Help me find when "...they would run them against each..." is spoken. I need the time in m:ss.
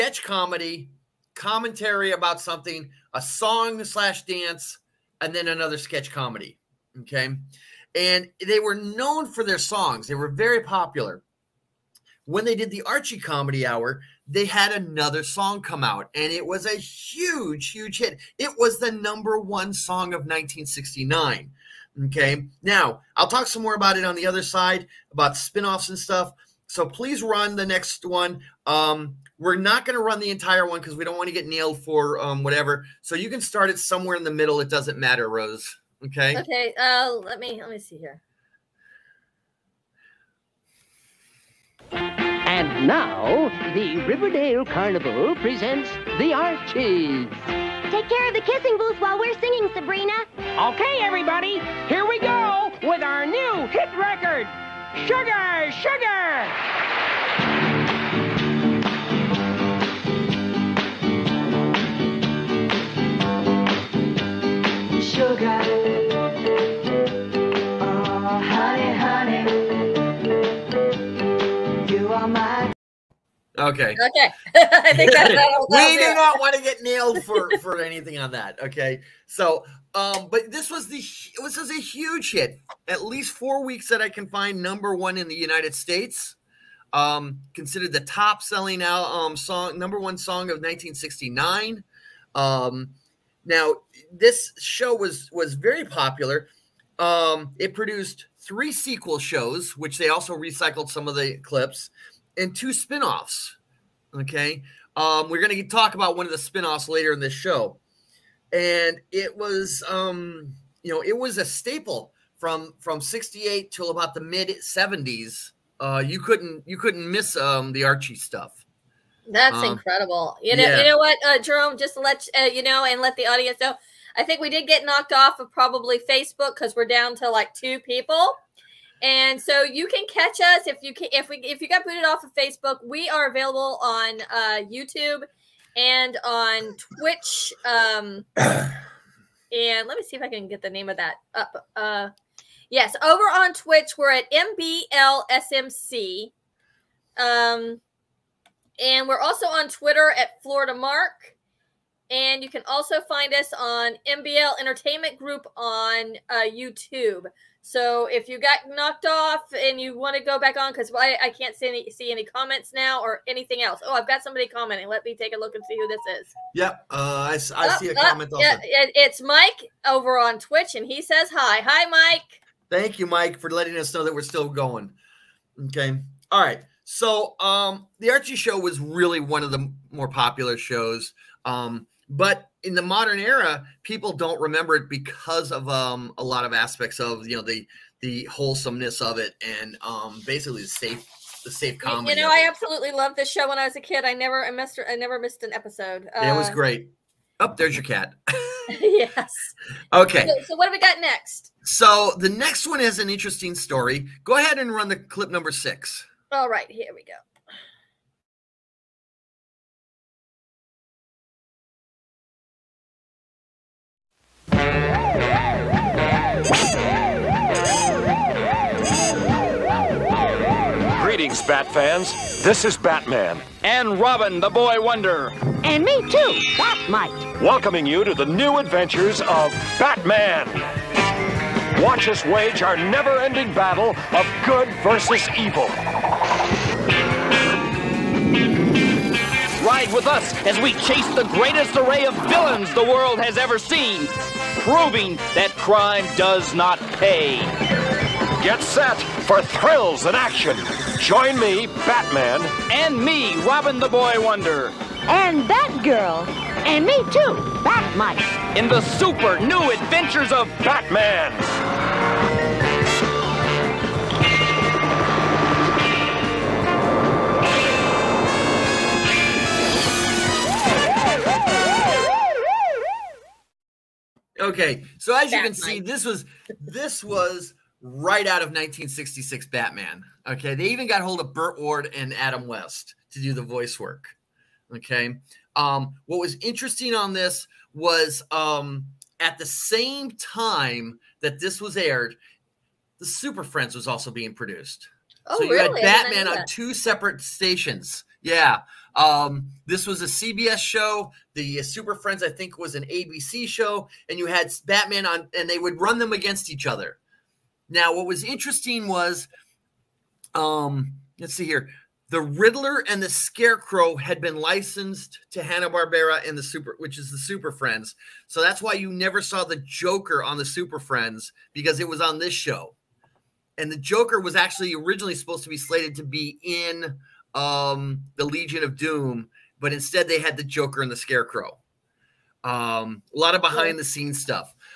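5:05.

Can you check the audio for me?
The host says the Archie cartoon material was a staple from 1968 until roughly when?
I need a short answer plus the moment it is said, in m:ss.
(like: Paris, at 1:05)
The mid 70s, at 1:54.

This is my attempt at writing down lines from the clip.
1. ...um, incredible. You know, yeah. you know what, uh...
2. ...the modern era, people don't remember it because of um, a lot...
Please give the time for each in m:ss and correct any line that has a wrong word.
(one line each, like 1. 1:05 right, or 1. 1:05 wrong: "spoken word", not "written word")
1. 1:59 right
2. 3:02 right.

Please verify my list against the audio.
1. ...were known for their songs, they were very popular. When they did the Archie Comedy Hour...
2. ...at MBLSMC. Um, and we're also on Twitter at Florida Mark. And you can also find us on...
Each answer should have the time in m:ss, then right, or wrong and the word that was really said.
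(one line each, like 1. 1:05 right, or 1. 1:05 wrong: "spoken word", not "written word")
1. 0:08 right
2. 2:24 right.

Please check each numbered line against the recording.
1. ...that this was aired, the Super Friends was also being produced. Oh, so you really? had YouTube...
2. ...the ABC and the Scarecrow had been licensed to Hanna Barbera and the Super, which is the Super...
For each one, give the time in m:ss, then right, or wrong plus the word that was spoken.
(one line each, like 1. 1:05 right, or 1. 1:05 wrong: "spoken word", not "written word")
1. 4:51 wrong: "Batman", not "YouTube"
2. 5:12 wrong: "Riddler", not "ABC".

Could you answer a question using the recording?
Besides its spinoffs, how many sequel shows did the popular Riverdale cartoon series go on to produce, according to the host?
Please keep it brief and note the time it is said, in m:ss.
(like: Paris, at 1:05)
3, at 1:38.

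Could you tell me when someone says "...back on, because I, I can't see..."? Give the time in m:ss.
2:40.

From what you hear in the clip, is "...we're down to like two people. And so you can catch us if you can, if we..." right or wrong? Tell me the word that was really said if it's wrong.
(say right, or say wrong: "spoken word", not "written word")
right.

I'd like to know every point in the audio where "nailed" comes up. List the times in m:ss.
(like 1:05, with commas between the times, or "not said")
0:31, 1:16.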